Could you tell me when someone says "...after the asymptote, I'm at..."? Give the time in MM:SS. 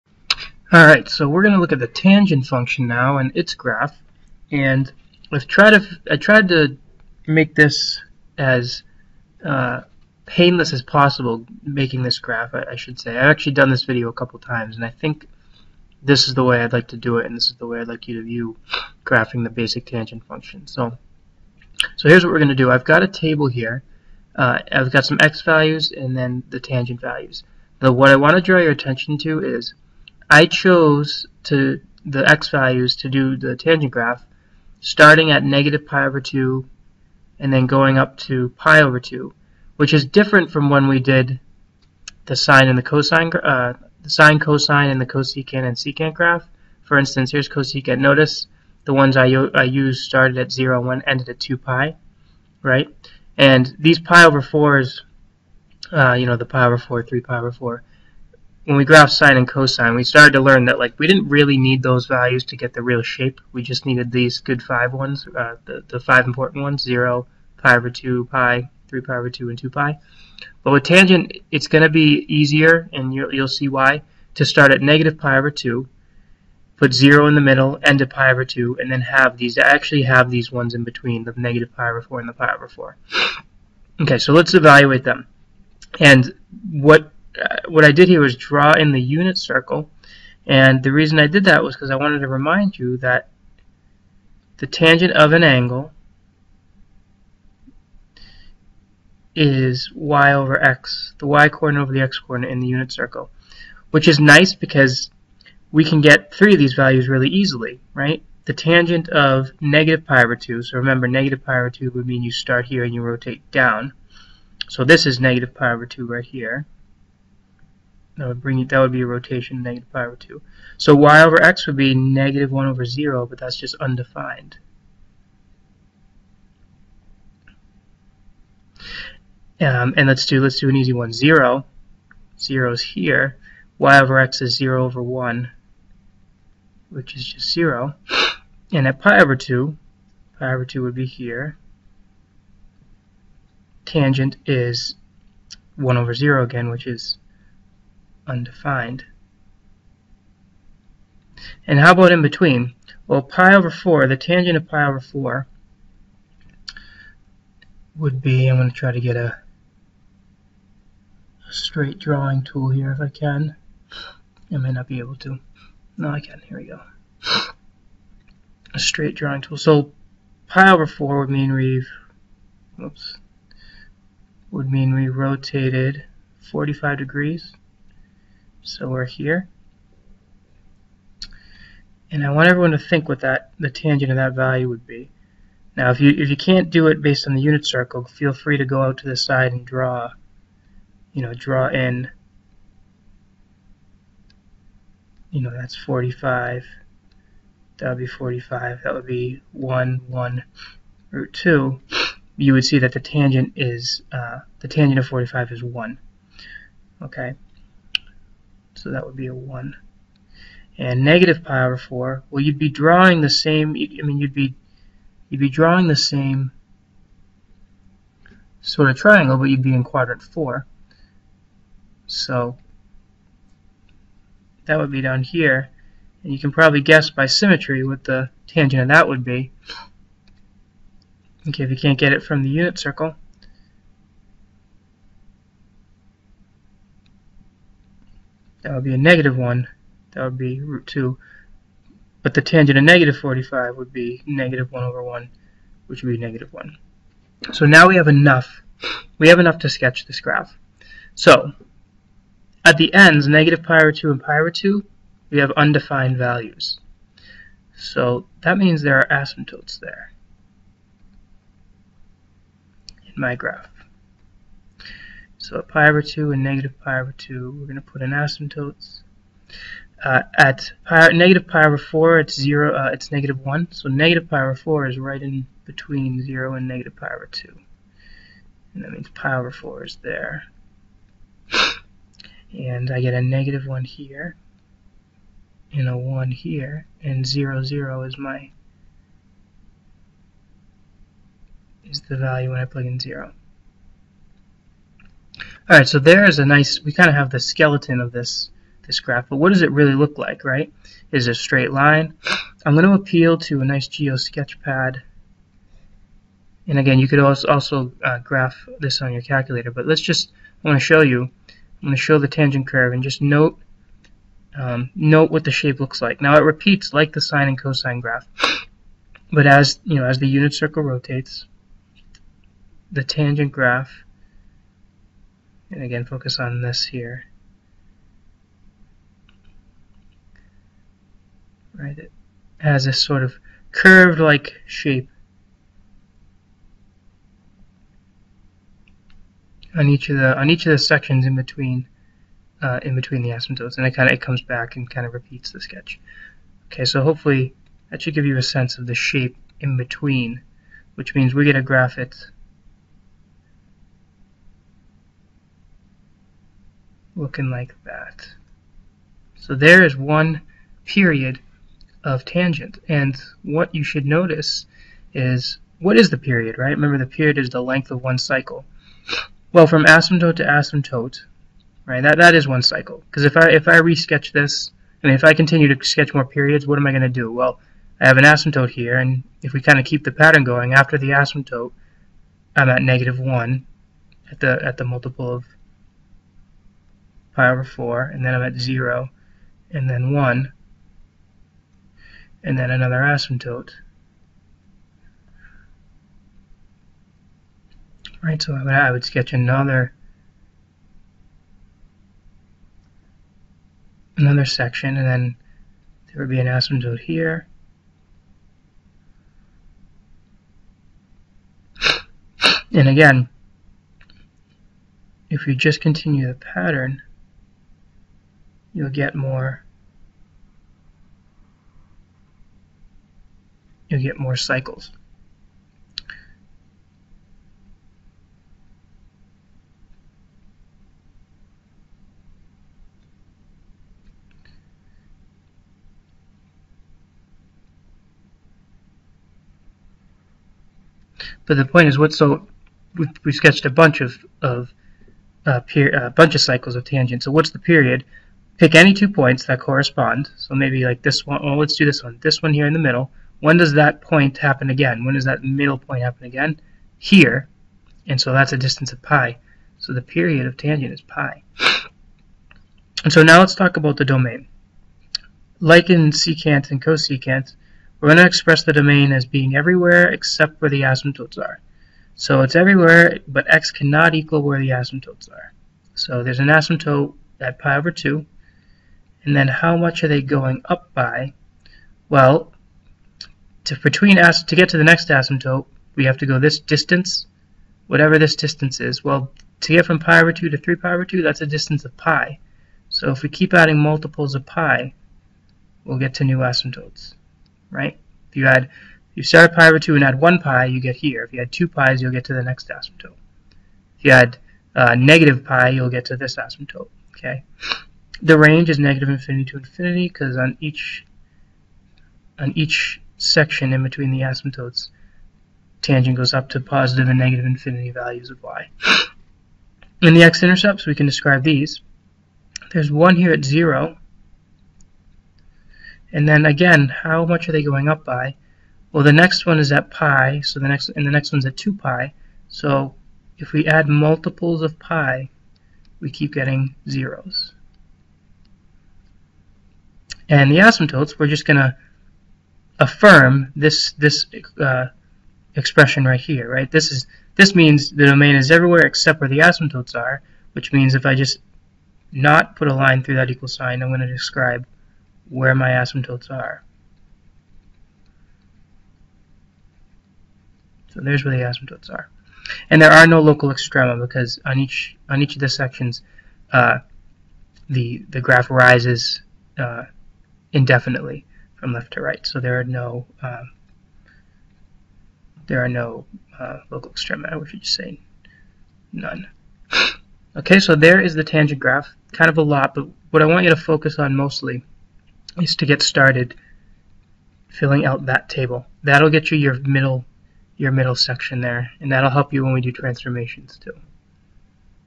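06:20.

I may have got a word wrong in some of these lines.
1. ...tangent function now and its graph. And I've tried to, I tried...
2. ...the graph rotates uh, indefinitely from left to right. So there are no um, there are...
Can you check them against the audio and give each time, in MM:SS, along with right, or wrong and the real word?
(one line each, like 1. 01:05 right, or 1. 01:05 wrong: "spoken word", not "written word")
1. 00:01 right
2. 09:28 wrong: "rises", not "rotates".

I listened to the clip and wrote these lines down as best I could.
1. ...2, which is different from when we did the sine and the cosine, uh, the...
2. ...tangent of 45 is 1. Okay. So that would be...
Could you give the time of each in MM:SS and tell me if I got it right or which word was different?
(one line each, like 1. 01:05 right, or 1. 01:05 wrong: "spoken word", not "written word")
1. 00:39 right
2. 03:24 right.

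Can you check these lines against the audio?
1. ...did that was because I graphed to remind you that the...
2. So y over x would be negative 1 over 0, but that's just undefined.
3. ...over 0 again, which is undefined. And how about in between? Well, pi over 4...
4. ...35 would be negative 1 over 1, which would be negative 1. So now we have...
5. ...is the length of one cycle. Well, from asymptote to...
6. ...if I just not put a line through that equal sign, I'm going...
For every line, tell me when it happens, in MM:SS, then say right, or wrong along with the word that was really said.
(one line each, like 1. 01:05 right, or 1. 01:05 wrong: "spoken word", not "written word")
1. 01:31 wrong: "wanted", not "graphed"
2. 02:00 right
3. 02:25 right
4. 04:03 wrong: "45", not "35"
5. 06:07 right
6. 09:10 right.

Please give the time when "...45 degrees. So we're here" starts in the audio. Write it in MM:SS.
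02:56.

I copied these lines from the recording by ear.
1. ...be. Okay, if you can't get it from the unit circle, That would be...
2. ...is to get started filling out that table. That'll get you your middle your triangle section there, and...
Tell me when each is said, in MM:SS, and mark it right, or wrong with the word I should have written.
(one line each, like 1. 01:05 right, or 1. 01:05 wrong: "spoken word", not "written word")
1. 03:49 right
2. 09:45 wrong: "middle", not "triangle".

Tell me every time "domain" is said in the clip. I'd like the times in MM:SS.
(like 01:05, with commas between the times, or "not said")
07:44, 07:48, 09:08.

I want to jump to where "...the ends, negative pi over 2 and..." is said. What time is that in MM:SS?
04:12.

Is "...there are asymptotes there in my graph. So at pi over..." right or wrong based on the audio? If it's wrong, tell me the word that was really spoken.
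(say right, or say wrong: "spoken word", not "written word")
right.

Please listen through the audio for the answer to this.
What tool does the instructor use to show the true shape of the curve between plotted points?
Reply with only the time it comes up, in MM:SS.
05:03.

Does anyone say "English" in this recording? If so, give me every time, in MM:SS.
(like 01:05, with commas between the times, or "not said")
not said.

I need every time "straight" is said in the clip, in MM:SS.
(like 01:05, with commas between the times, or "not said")
02:41, 02:48, 05:01.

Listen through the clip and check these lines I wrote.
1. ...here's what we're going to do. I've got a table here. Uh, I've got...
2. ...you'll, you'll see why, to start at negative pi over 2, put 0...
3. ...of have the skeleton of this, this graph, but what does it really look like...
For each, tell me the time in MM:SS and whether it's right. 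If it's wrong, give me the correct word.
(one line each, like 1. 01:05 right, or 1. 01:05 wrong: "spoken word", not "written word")
1. 00:22 right
2. 01:13 right
3. 04:57 right.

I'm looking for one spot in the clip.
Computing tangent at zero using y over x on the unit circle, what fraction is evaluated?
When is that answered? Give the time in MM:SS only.
02:14.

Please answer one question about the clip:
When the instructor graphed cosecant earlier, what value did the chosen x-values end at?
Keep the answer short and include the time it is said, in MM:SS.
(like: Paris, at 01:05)
2 pi, at 00:51.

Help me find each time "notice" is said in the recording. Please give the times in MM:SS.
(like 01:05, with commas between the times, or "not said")
00:47, 06:04.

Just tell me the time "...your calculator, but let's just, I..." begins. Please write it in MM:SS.
05:09.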